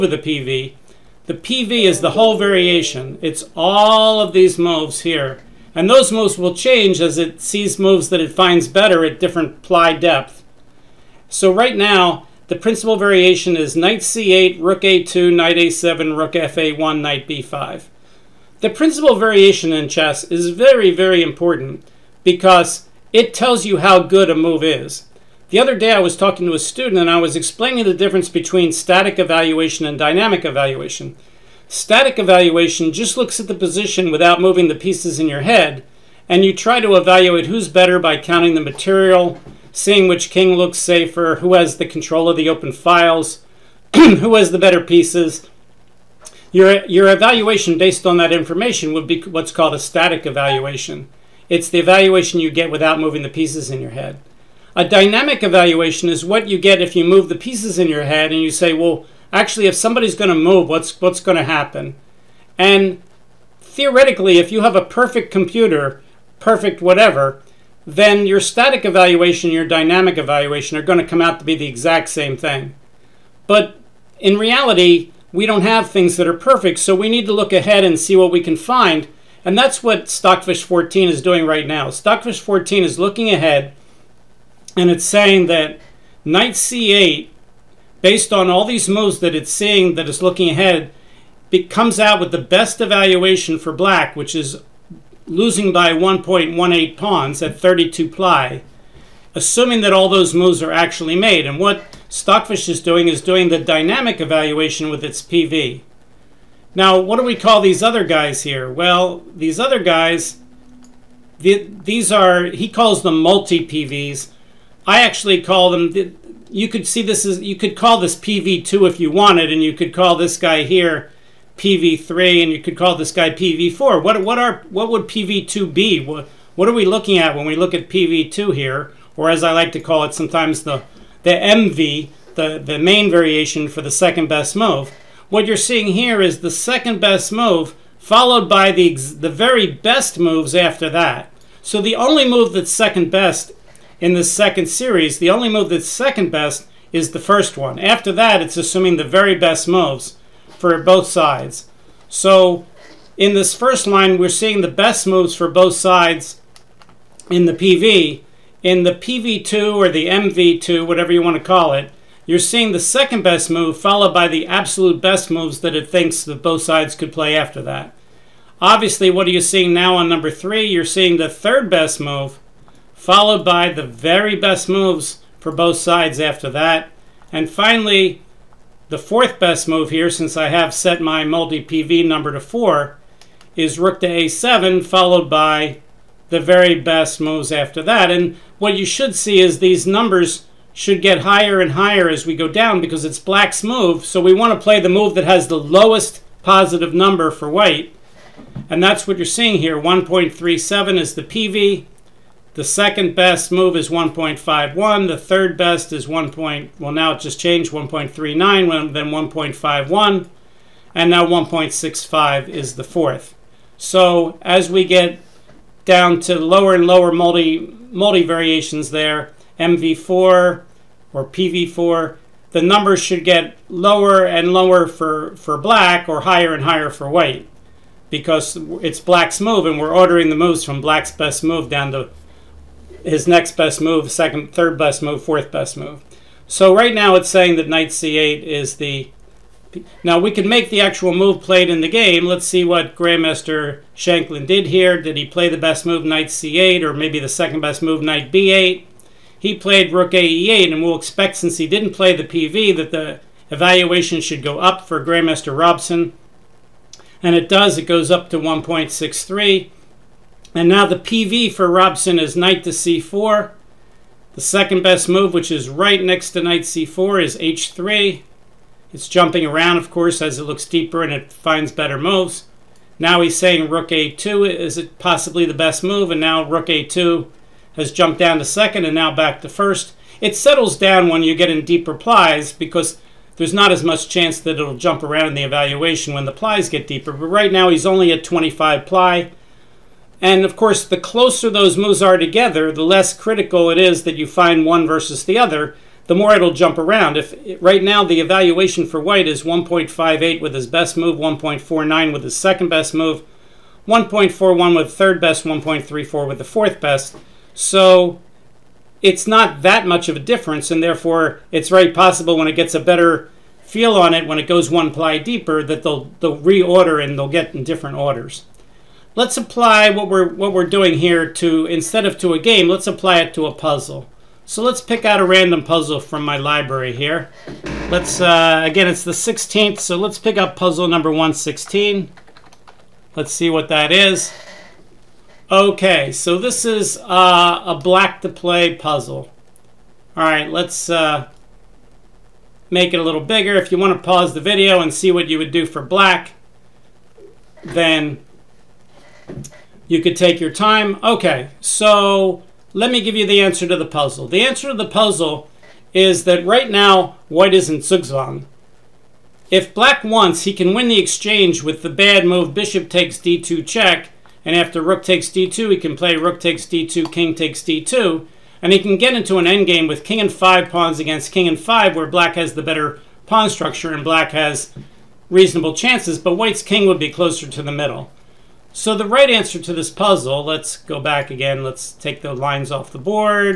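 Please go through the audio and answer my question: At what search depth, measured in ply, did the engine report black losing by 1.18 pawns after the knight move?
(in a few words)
32.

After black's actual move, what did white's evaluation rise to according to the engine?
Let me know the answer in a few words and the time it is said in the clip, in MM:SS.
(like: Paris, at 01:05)
1.63, at 04:18.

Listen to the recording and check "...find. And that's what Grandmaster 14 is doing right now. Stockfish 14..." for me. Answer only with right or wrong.
wrong.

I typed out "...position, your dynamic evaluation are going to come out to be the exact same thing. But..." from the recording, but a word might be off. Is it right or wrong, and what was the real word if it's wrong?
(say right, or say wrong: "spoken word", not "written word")
wrong: "evaluation", not "position".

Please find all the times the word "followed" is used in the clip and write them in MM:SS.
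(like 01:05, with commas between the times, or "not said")
02:17, 02:43, 02:53, 03:04.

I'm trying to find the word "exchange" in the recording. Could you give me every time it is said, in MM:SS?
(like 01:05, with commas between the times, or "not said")
06:01.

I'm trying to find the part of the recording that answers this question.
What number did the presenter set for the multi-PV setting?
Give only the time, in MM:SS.
03:02.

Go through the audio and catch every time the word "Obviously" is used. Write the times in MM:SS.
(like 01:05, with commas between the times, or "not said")
02:48.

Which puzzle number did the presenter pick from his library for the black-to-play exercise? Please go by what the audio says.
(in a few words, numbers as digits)
116.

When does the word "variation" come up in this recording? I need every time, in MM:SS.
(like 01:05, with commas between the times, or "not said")
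00:02, 00:12, 00:19, 02:13, 03:38.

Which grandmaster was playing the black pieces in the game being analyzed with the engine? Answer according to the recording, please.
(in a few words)
Shankland.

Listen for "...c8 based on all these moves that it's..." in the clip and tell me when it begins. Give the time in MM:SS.
01:26.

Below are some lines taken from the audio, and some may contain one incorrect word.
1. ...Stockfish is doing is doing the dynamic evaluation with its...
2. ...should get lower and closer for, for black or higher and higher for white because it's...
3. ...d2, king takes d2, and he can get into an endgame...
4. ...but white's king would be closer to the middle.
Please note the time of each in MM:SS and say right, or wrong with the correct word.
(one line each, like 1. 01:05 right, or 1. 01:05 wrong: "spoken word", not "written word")
1. 01:42 right
2. 03:43 wrong: "lower", not "closer"
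3. 06:06 right
4. 06:16 right.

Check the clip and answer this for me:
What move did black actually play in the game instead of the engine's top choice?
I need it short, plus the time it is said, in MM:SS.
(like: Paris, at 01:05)
Rook ae8, at 04:09.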